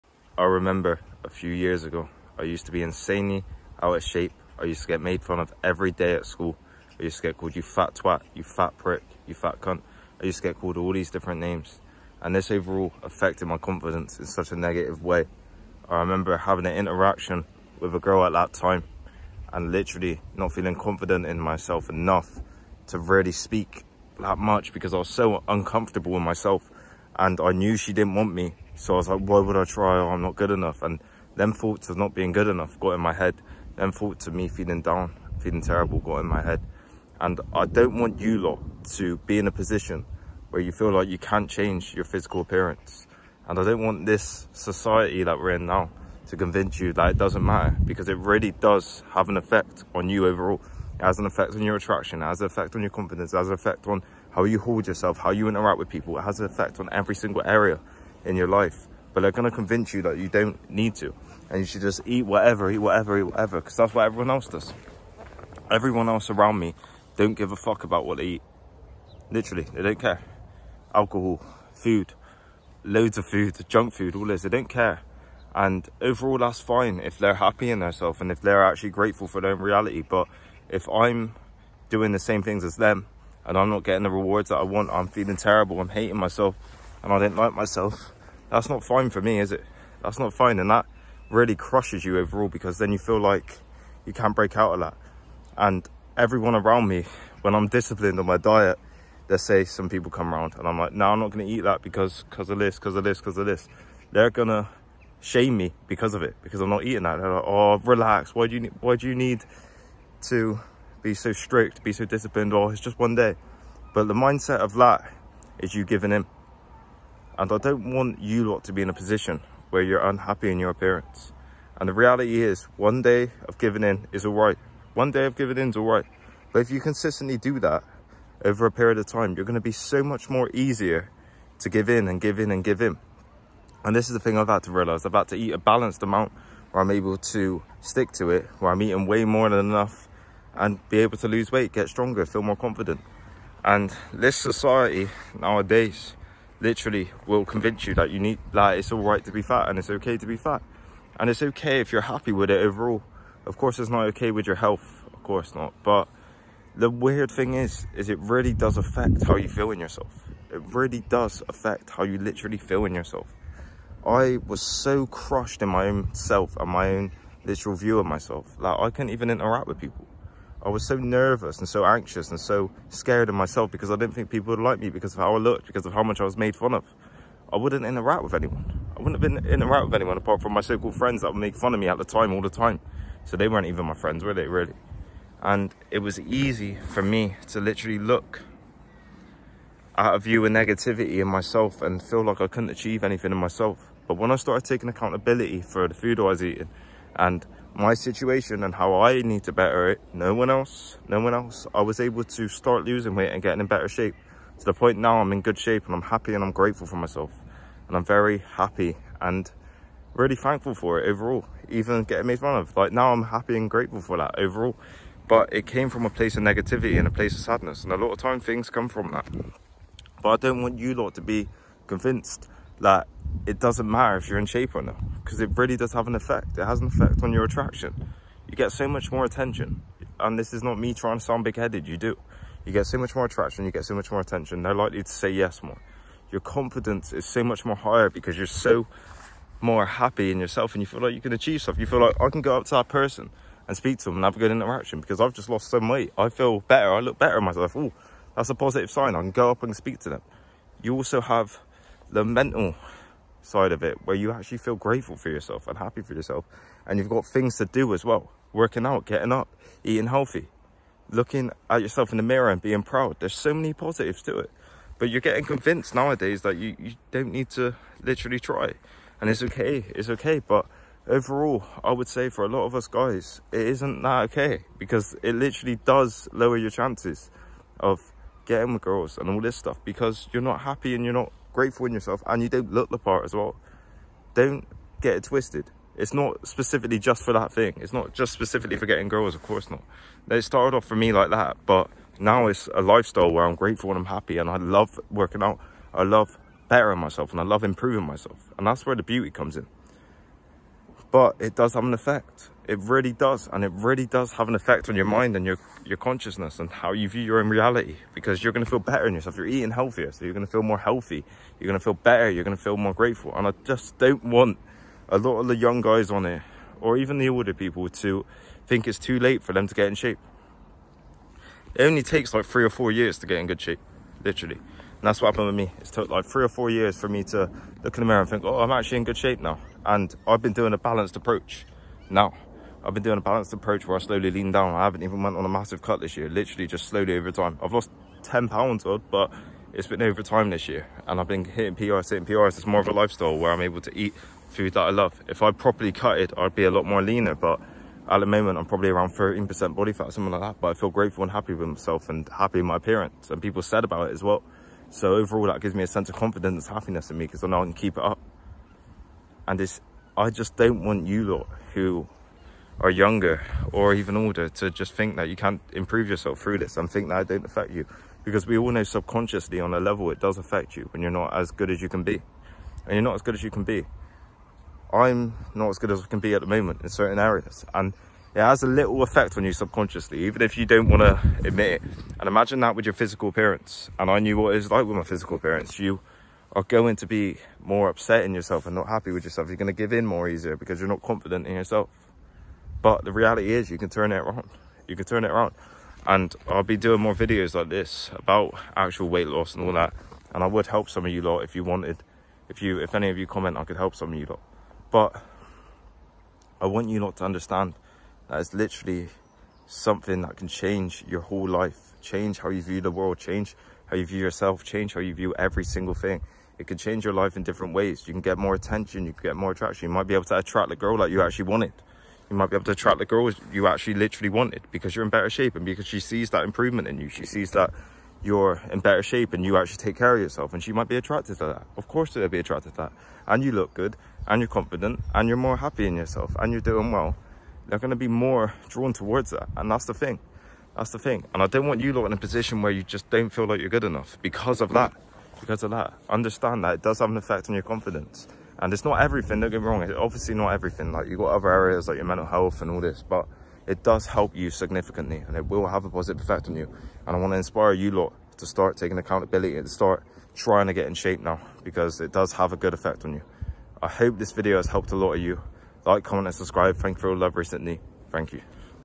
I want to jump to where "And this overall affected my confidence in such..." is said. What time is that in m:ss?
0:12.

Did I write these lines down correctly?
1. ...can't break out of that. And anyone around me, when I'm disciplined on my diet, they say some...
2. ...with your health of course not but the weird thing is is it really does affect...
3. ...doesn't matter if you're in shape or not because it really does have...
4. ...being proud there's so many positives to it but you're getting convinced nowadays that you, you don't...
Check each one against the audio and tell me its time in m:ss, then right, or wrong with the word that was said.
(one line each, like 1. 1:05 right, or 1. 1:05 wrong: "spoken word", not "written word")
1. 1:34 wrong: "everyone", not "anyone"
2. 2:34 right
3. 3:43 right
4. 4:22 right.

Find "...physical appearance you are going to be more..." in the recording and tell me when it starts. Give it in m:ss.
6:25.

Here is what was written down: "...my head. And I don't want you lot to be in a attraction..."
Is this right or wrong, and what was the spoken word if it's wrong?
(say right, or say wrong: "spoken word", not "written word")
wrong: "position", not "attraction".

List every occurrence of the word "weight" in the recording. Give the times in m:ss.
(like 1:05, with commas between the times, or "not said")
2:21, 3:23, 4:05, 6:39.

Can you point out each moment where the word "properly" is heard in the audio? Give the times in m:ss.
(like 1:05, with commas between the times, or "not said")
5:45.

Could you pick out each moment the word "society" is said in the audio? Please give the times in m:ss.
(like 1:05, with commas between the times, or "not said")
0:44, 2:24.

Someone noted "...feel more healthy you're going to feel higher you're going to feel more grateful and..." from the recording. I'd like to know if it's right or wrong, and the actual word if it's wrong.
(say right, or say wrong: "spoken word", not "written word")
wrong: "better", not "higher".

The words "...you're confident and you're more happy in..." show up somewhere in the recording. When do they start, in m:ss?
7:14.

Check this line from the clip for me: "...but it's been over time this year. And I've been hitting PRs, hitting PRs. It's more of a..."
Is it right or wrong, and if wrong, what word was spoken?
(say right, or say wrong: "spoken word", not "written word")
right.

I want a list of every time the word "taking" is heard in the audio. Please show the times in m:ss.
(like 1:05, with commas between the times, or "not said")
3:14, 7:38.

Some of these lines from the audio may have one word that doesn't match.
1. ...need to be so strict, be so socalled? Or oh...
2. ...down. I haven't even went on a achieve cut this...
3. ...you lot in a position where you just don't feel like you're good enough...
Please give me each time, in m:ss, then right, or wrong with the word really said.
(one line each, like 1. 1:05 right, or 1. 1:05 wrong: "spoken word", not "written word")
1. 1:49 wrong: "disciplined", not "socalled"
2. 5:34 wrong: "massive", not "achieve"
3. 7:21 right.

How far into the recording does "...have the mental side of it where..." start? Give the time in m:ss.
4:11.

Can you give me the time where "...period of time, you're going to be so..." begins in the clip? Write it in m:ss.
2:08.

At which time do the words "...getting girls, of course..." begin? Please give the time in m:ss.
4:48.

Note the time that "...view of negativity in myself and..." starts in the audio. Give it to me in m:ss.
3:10.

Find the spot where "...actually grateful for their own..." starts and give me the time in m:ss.
1:18.